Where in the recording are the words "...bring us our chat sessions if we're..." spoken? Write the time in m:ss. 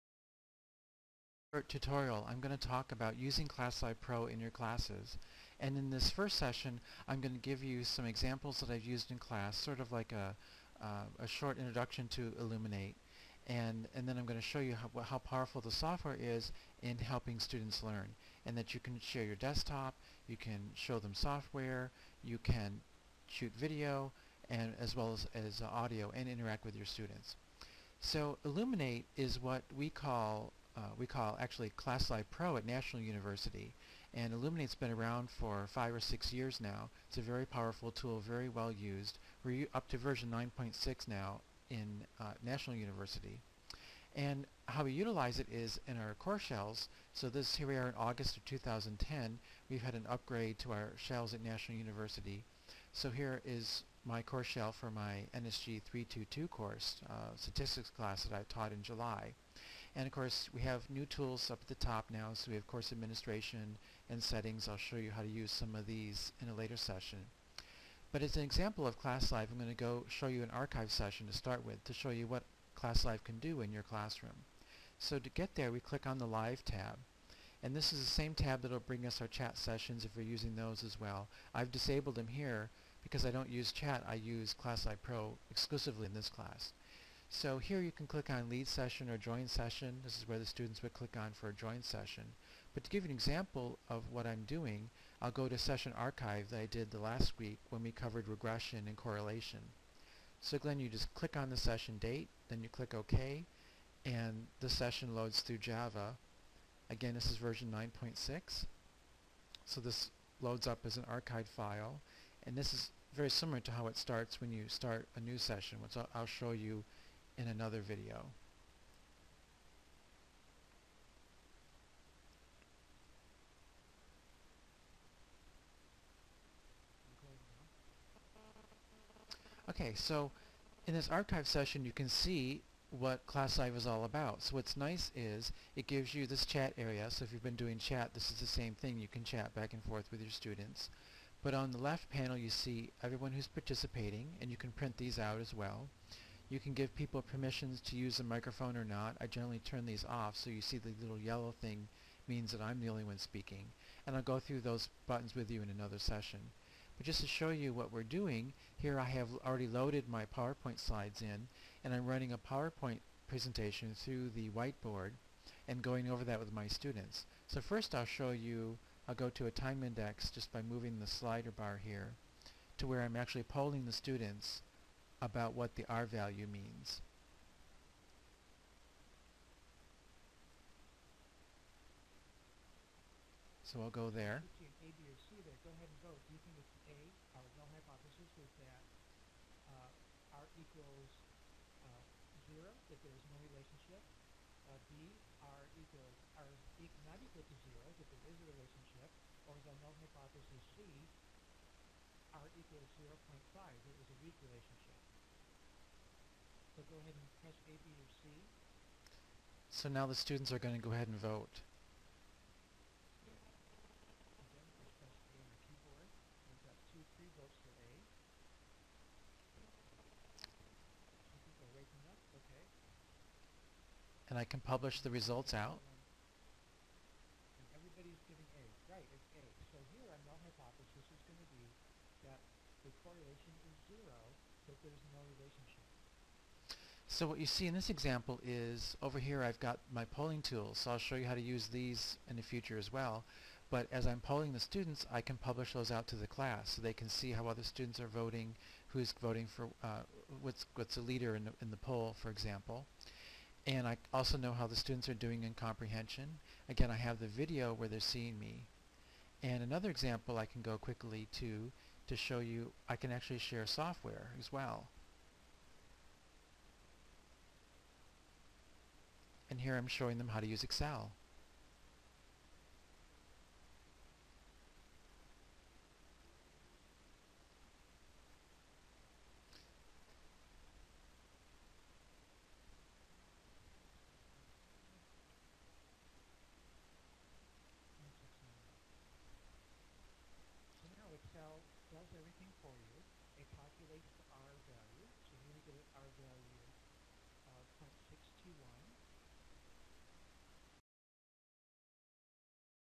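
1:18.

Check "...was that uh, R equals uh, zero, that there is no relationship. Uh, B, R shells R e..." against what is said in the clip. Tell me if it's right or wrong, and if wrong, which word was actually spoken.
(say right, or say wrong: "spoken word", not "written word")
wrong: "equals", not "shells".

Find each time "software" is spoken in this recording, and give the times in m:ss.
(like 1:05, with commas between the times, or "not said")
0:15, 0:21, 4:23.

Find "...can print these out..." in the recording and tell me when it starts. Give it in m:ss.
2:24.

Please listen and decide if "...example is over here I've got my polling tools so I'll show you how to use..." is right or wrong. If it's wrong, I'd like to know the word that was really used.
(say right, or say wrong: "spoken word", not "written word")
right.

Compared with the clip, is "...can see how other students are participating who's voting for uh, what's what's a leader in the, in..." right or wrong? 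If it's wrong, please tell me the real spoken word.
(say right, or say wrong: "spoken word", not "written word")
wrong: "voting", not "participating".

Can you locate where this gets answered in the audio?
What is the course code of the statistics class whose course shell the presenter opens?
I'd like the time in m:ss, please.
0:55.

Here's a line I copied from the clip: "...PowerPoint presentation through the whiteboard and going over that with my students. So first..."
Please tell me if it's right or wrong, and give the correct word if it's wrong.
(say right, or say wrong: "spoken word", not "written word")
right.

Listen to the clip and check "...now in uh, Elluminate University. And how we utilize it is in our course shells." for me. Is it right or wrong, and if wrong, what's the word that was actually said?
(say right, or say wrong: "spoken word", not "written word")
wrong: "National", not "Elluminate".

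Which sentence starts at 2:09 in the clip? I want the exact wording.
Okay, so in this archive session you can see what live is all about.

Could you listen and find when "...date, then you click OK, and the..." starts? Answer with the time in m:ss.
1:41.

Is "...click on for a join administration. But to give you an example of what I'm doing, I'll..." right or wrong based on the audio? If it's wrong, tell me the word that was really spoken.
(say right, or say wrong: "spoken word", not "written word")
wrong: "session", not "administration".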